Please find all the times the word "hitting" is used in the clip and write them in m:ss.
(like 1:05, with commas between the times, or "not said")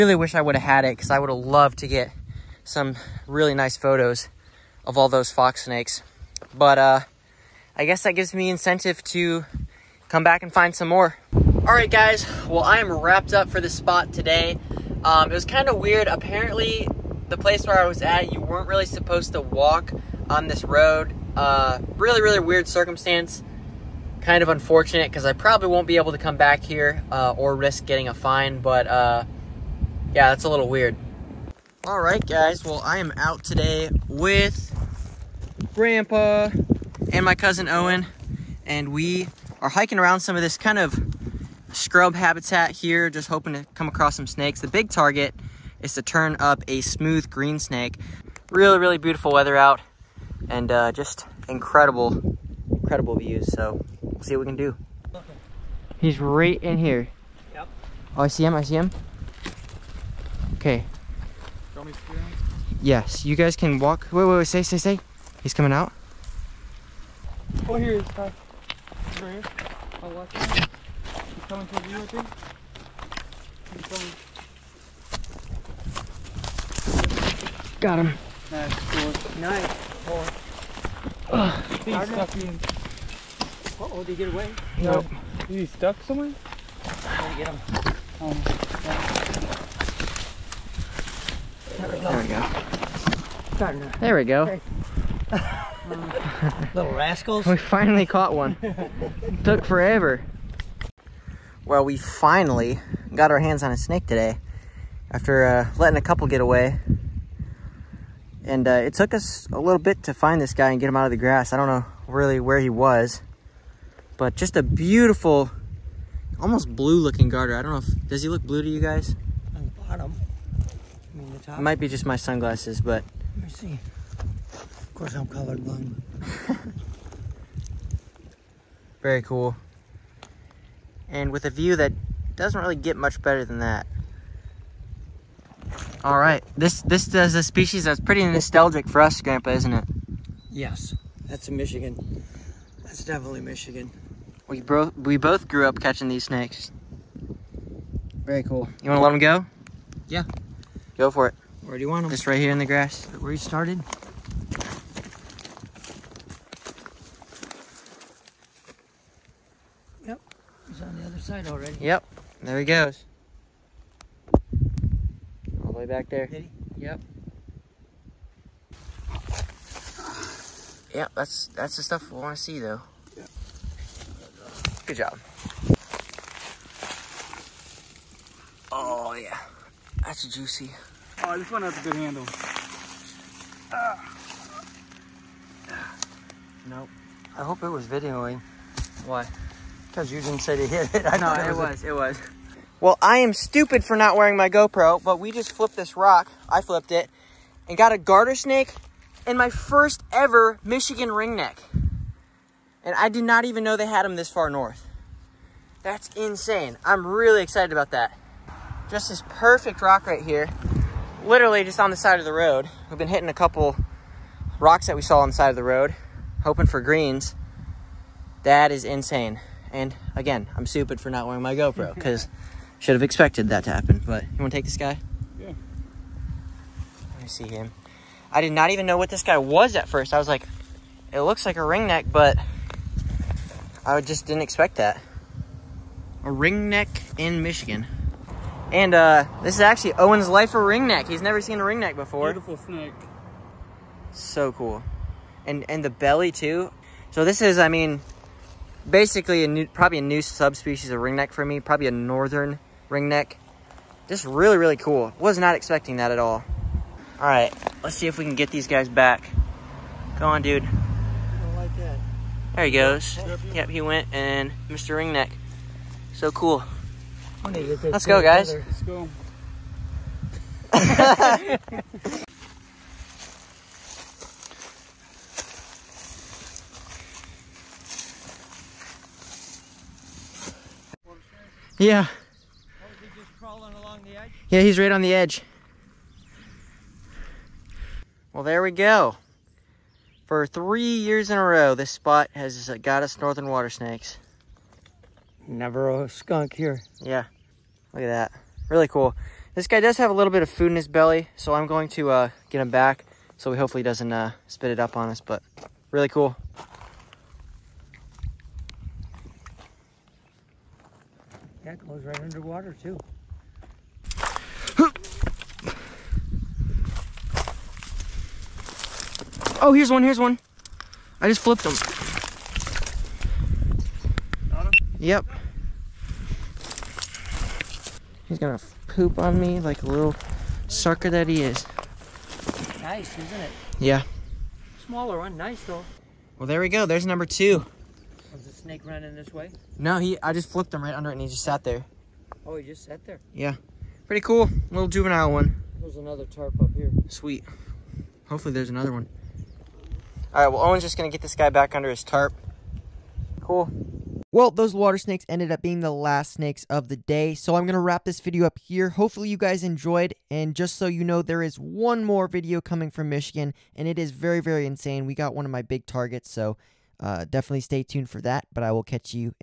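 3:33.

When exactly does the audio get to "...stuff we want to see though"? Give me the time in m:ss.
2:51.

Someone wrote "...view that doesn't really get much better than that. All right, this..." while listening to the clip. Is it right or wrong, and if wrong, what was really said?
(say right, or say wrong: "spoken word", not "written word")
right.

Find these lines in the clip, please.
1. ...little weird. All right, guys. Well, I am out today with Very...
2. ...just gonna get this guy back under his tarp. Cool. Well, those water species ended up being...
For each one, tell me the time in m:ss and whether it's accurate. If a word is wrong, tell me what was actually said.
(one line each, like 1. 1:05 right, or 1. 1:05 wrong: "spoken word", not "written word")
1. 0:30 wrong: "Grandpa", not "Very"
2. 5:50 wrong: "snakes", not "species".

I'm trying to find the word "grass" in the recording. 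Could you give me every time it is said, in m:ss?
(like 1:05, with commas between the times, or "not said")
1:51, 2:32.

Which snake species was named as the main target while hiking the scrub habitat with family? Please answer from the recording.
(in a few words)
Smooth green snake.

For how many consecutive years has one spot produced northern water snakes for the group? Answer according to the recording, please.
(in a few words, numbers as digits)
3.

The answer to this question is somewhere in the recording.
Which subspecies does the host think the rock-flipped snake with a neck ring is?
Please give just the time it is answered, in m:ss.
4:11.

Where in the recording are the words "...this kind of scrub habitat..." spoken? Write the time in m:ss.
0:40.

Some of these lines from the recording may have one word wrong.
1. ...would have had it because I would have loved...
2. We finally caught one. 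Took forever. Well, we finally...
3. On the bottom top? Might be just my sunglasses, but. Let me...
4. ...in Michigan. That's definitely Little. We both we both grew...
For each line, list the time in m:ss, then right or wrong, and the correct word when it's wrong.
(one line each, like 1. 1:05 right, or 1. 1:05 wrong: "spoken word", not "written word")
1. 0:00 right
2. 1:37 right
3. 1:59 right
4. 2:21 wrong: "Michigan", not "Little".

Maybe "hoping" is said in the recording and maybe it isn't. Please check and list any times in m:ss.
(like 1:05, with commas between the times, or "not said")
0:43, 3:36.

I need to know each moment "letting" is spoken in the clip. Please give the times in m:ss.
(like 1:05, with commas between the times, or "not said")
1:45.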